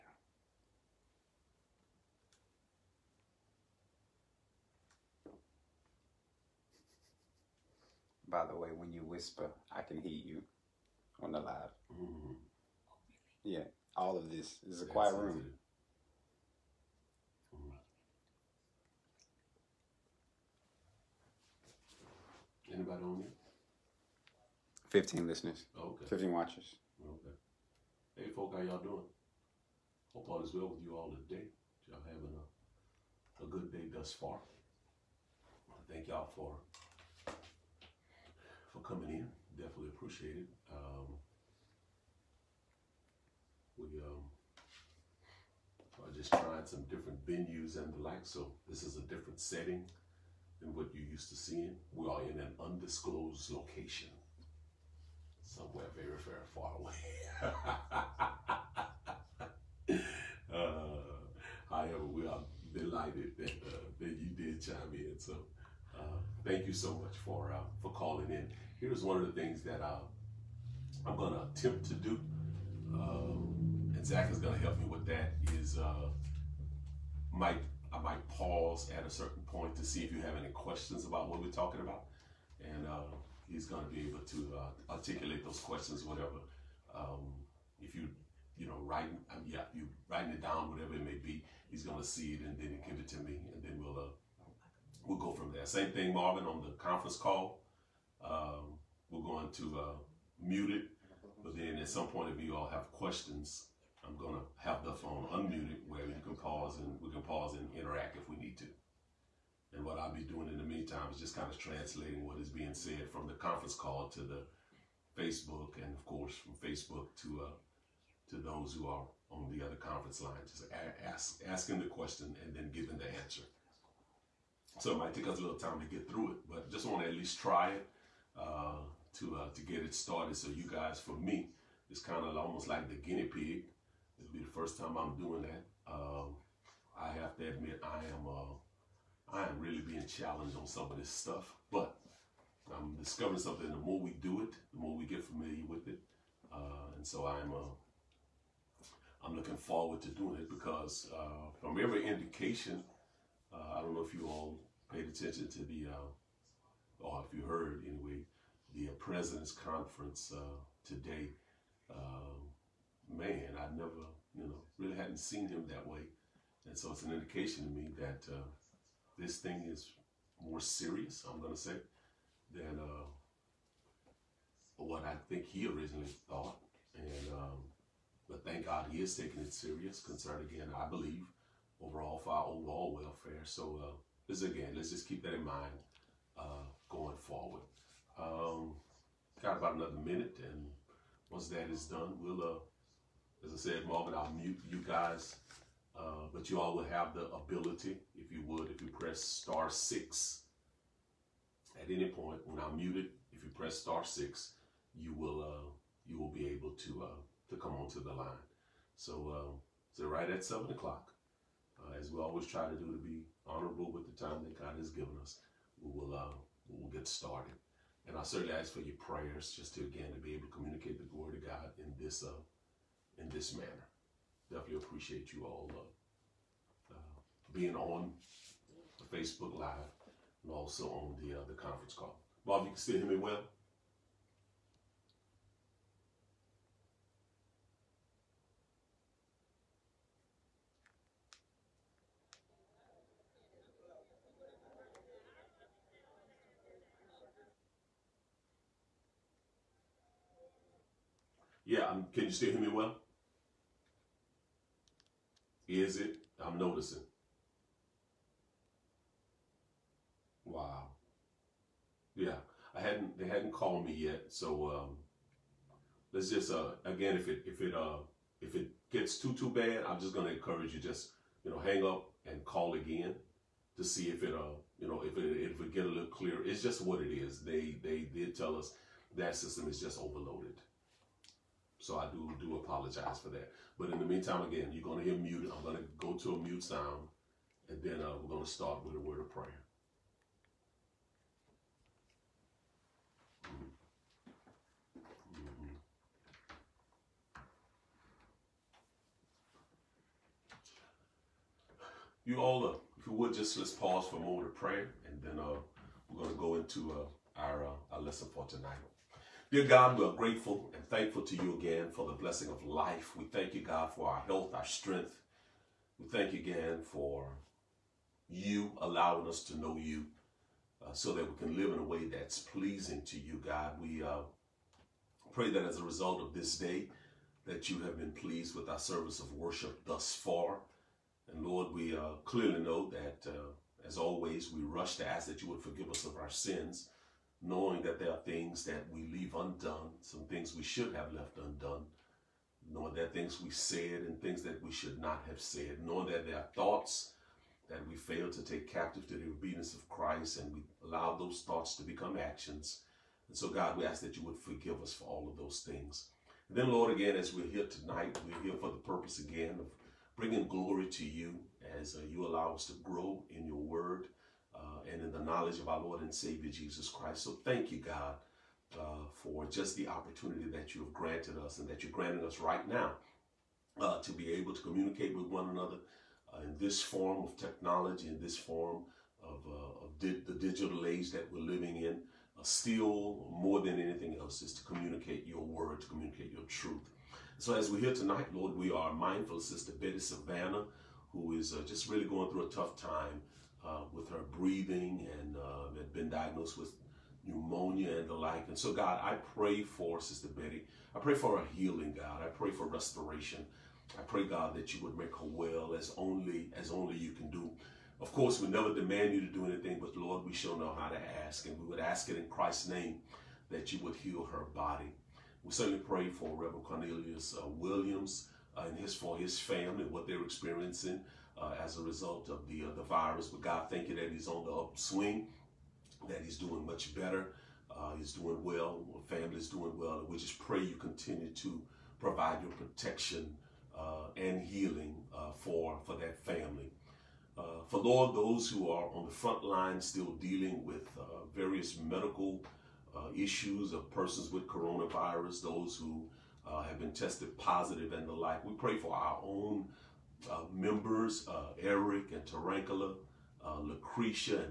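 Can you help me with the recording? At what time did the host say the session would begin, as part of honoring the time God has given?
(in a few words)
7 o'clock.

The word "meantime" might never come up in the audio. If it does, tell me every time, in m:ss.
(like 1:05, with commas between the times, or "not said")
1:50, 4:44.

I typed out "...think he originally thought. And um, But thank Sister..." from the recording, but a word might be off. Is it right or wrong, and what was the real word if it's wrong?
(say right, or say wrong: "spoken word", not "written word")
wrong: "God", not "Sister".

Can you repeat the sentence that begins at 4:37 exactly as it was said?
They they did tell us that system is just overloaded.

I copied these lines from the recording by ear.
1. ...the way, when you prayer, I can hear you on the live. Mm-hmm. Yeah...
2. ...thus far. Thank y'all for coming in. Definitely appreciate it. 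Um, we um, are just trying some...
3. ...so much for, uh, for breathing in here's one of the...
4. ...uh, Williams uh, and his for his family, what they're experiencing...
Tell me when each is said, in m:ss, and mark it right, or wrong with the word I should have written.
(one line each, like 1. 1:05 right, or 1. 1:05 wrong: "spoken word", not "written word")
1. 0:08 wrong: "whisper", not "prayer"
2. 0:33 right
3. 1:06 wrong: "calling", not "breathing"
4. 6:57 right.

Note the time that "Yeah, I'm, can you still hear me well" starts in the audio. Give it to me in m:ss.
4:11.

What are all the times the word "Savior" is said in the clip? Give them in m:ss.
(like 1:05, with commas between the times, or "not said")
6:06.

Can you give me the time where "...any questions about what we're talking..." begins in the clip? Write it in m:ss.
1:20.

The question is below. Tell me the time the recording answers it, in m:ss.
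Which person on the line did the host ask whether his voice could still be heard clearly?
3:52.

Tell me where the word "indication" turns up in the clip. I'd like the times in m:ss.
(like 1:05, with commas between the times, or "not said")
2:32, 2:47.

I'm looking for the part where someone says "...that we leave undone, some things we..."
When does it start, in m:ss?
5:38.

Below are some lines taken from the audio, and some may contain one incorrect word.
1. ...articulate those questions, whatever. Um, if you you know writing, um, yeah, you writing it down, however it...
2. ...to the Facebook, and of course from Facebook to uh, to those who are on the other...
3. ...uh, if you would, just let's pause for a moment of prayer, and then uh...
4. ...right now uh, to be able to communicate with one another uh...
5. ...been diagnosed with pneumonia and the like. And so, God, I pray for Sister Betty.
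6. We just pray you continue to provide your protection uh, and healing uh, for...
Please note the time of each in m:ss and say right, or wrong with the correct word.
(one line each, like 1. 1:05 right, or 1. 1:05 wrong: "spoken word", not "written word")
1. 1:24 wrong: "whatever", not "however"
2. 1:54 right
3. 5:02 right
4. 6:12 right
5. 6:35 right
6. 7:10 right.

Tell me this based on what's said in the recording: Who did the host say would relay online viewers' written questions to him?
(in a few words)
Zach.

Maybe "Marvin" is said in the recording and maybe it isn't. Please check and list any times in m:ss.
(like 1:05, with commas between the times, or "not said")
1:36, 3:13.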